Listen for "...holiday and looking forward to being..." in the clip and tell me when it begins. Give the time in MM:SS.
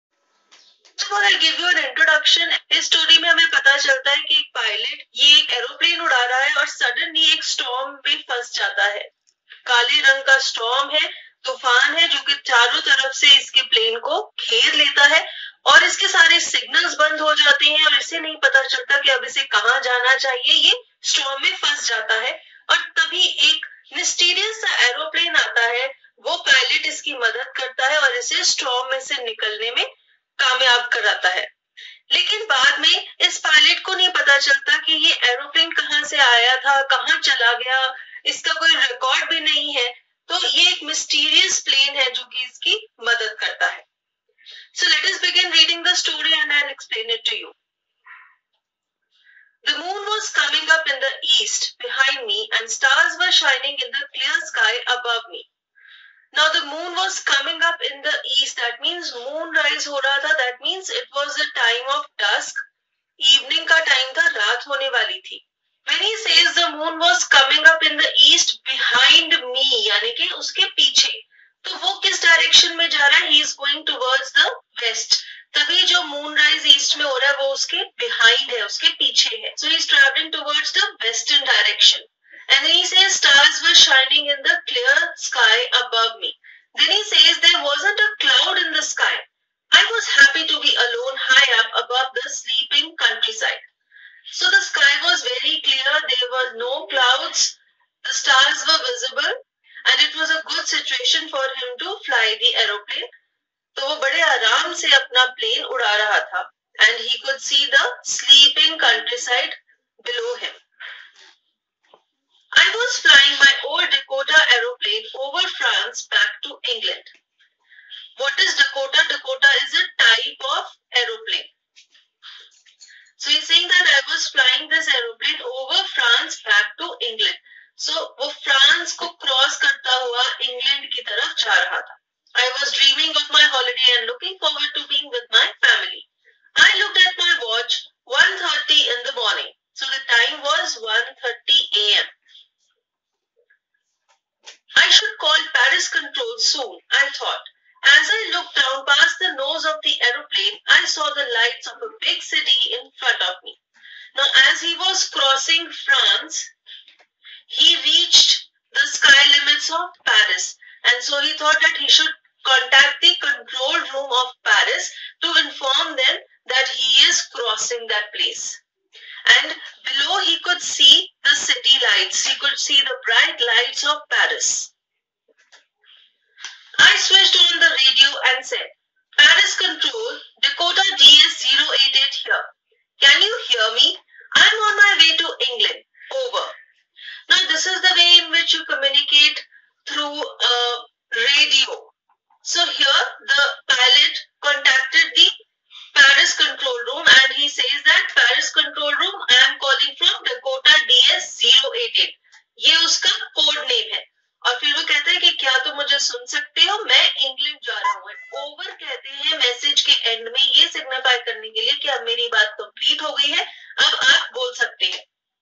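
02:13.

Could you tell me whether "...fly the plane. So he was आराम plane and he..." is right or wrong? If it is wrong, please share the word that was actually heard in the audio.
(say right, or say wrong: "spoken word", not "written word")
wrong: "aeroplane", not "plane".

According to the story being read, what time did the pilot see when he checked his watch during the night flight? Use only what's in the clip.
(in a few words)
1.30 a.m.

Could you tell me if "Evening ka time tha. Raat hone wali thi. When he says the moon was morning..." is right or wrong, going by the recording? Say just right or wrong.
wrong.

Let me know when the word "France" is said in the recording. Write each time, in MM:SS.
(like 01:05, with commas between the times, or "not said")
02:35.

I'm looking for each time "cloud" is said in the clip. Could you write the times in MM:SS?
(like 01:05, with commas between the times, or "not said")
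01:28, 01:36.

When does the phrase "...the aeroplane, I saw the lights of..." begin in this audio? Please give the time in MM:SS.
02:29.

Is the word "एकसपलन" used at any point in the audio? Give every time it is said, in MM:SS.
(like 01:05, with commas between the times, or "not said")
00:46.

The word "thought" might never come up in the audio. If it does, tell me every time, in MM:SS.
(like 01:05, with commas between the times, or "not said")
02:27, 02:41.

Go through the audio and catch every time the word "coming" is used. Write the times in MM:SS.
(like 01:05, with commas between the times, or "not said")
00:57, 01:07.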